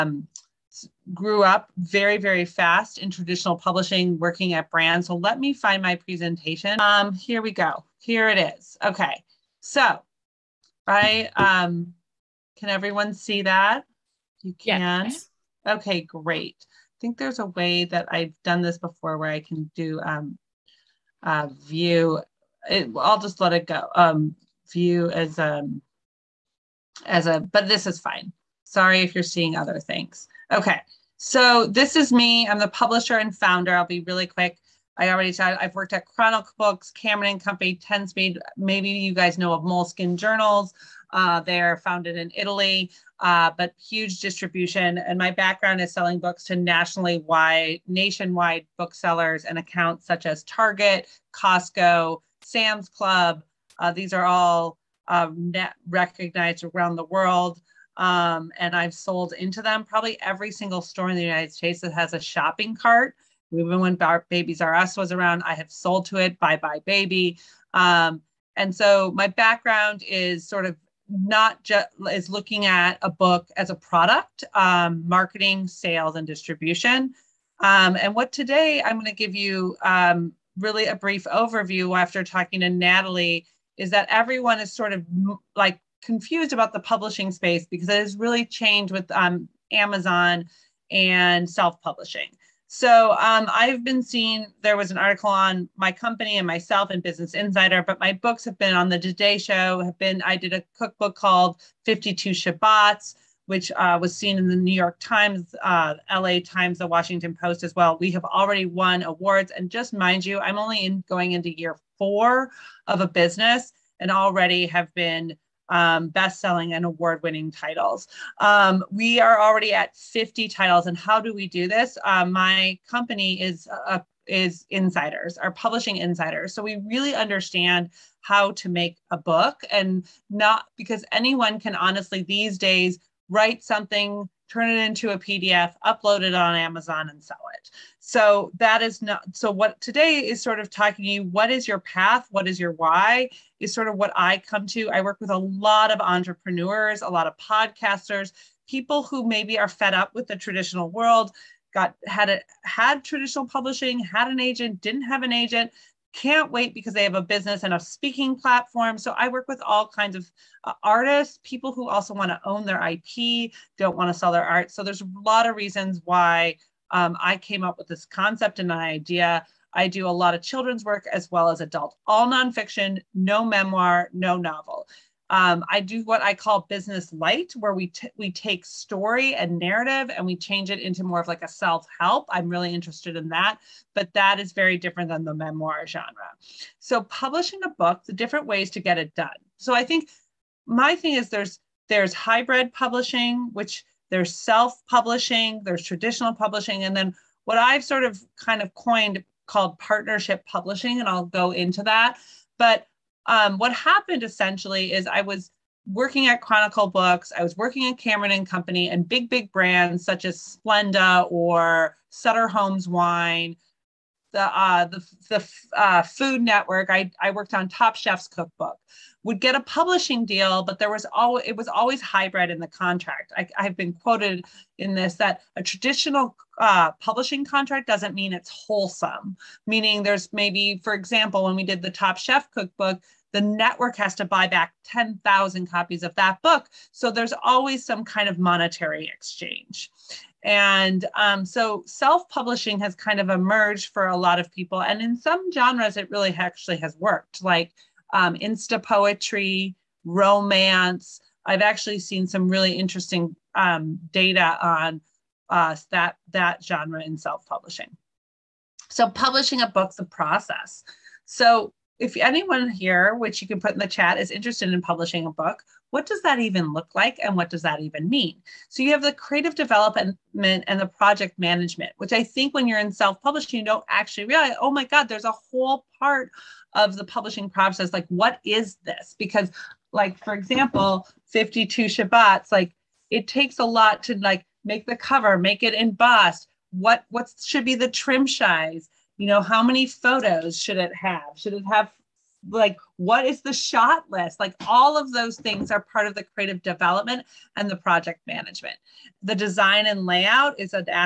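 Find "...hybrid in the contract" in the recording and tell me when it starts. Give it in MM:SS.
03:42.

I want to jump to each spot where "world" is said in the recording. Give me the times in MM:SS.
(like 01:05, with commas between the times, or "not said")
00:57, 02:30.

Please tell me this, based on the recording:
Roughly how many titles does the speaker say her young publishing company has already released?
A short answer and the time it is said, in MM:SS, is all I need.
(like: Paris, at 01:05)
50, at 01:59.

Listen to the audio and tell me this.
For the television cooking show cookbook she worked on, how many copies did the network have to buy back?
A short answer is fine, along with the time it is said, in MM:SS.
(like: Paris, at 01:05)
10,000, at 03:54.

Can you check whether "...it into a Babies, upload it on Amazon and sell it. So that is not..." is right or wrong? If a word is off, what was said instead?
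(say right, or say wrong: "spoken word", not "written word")
wrong: "PDF", not "Babies".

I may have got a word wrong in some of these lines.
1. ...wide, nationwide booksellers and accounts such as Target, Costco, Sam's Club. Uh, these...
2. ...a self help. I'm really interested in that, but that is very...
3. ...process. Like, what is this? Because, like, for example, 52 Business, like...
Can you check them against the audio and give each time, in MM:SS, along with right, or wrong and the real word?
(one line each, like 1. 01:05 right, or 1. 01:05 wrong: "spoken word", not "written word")
1. 00:47 right
2. 03:01 right
3. 04:37 wrong: "Shabbats", not "Business".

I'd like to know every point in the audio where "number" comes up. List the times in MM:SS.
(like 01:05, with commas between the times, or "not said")
not said.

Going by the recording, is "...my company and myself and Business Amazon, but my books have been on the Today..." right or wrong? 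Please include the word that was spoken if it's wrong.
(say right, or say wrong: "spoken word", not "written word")
wrong: "Insider", not "Amazon".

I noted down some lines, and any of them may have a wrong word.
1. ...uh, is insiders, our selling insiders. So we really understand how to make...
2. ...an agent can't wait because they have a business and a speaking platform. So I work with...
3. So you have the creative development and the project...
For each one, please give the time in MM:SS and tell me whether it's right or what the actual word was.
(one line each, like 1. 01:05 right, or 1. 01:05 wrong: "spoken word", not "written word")
1. 02:03 wrong: "publishing", not "selling"
2. 02:35 right
3. 04:28 right.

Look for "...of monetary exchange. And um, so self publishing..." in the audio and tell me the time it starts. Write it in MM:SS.
03:58.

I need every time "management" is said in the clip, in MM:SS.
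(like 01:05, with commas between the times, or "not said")
04:31, 04:58.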